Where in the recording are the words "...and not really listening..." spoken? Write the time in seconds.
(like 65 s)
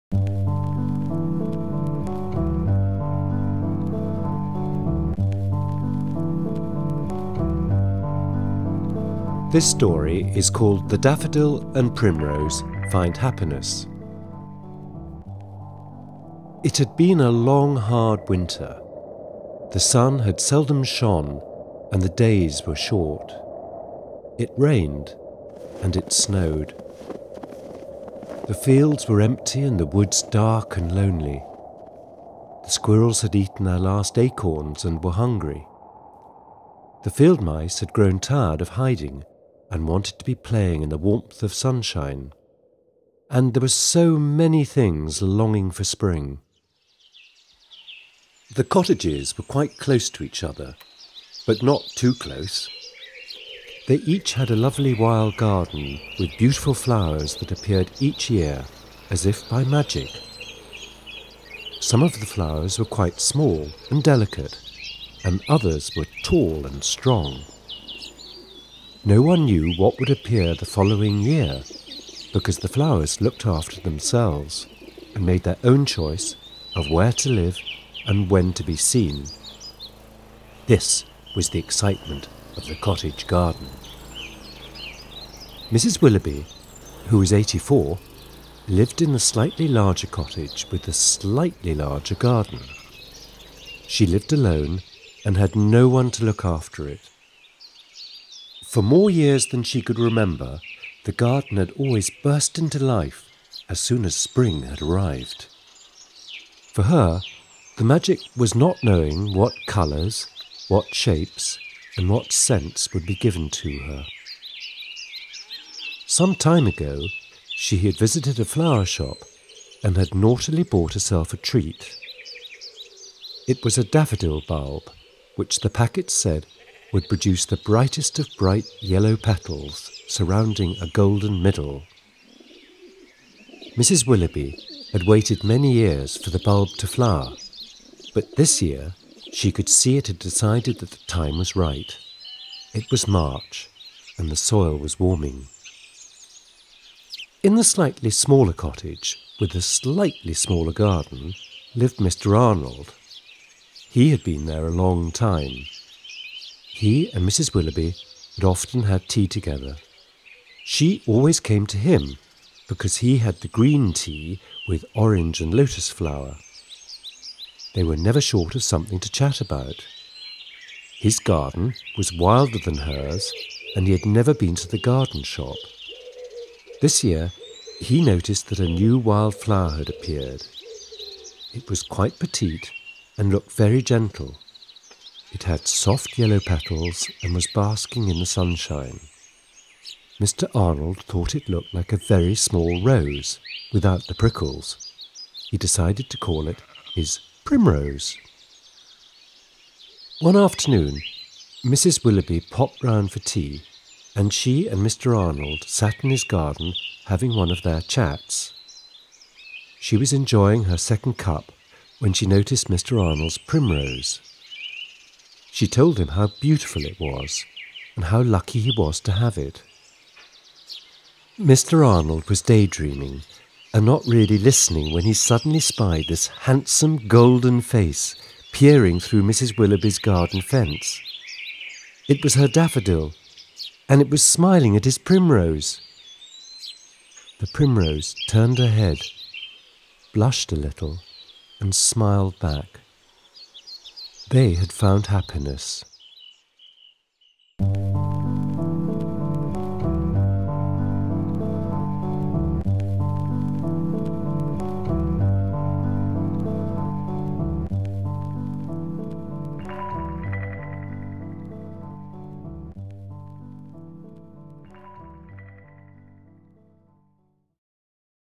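223 s.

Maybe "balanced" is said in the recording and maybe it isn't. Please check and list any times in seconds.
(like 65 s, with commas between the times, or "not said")
not said.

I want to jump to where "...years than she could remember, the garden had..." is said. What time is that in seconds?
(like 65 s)
99 s.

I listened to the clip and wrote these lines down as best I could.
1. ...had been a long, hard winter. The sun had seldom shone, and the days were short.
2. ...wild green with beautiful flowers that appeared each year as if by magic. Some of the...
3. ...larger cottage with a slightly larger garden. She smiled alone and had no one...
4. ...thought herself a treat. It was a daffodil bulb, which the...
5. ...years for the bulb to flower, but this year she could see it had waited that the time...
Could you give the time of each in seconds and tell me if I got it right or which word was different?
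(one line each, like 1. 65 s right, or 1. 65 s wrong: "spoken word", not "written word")
1. 16 s right
2. 54 s wrong: "garden", not "green"
3. 89 s wrong: "lived", not "smiled"
4. 120 s wrong: "bought", not "thought"
5. 135 s wrong: "decided", not "waited".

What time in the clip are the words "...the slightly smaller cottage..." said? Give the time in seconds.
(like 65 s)
147 s.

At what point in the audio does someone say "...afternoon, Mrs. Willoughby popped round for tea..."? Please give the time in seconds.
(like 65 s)
200 s.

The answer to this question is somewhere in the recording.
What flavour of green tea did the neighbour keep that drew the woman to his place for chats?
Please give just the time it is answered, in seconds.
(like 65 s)
164 s.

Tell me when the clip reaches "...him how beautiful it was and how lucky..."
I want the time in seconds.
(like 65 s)
215 s.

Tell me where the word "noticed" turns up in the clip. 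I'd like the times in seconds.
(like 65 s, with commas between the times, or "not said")
178 s, 212 s.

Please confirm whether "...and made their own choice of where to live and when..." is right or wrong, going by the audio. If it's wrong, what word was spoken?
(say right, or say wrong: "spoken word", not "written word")
right.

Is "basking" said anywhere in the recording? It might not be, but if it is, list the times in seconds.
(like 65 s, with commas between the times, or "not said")
187 s.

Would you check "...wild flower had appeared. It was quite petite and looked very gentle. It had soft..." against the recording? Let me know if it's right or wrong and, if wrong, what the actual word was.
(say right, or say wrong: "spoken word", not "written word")
right.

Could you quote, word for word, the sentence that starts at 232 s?
It was her daffodil, and it was smiling at his primrose.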